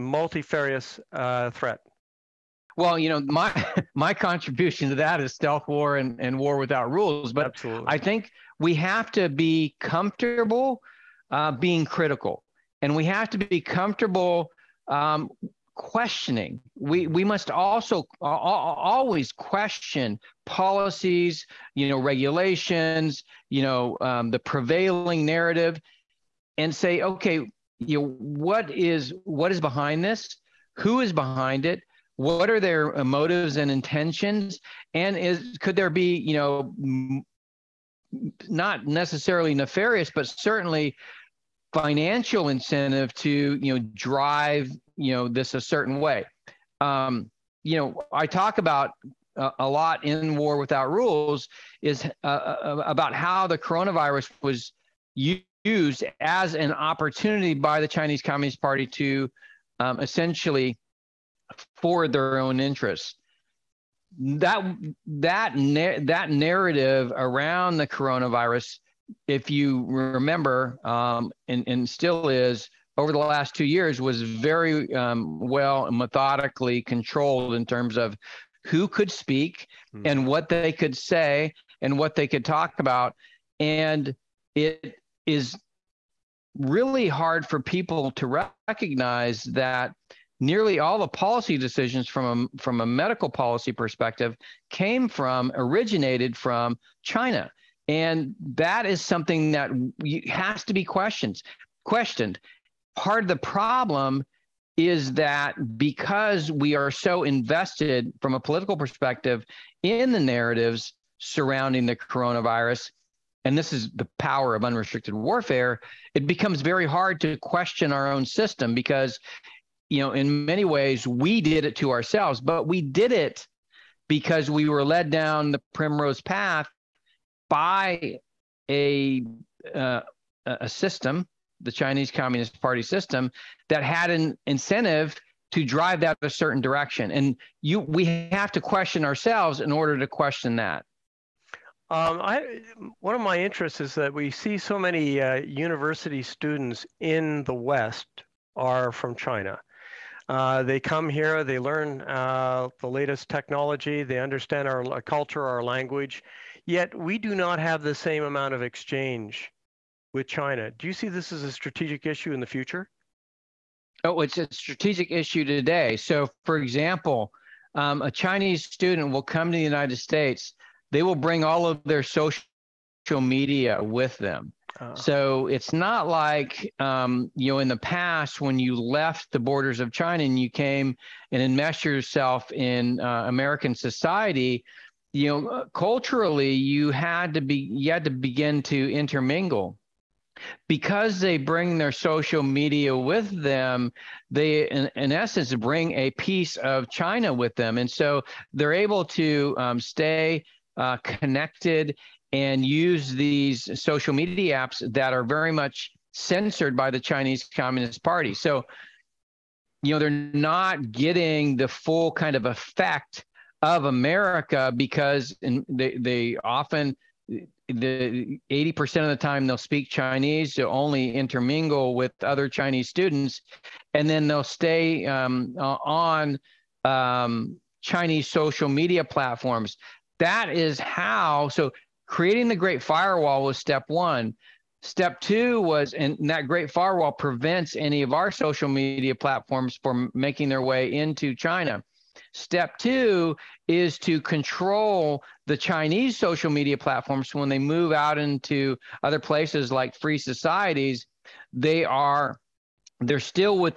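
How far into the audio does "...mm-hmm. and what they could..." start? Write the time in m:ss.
1:19.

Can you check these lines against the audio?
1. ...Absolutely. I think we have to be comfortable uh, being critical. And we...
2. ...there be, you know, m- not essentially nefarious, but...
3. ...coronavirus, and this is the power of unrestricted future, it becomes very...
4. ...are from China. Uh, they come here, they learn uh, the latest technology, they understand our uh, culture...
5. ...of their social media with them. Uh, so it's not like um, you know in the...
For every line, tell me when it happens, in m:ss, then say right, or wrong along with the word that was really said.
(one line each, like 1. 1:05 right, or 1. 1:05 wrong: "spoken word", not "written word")
1. 0:07 right
2. 0:35 wrong: "necessarily", not "essentially"
3. 1:51 wrong: "warfare", not "future"
4. 2:28 right
5. 2:51 right.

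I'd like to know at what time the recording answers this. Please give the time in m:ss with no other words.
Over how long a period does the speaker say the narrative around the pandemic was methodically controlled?
1:13.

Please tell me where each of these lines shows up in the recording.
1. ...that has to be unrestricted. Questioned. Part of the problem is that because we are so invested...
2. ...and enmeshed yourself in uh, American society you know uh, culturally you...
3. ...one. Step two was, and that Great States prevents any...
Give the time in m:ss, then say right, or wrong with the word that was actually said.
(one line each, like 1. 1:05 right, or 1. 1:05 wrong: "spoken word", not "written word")
1. 1:39 wrong: "questioned", not "unrestricted"
2. 3:01 right
3. 3:53 wrong: "Firewall", not "States".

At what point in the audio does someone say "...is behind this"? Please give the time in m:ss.
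0:29.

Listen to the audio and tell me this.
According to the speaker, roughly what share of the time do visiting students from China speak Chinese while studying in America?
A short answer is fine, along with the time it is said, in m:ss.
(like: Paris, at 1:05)
80%, at 3:38.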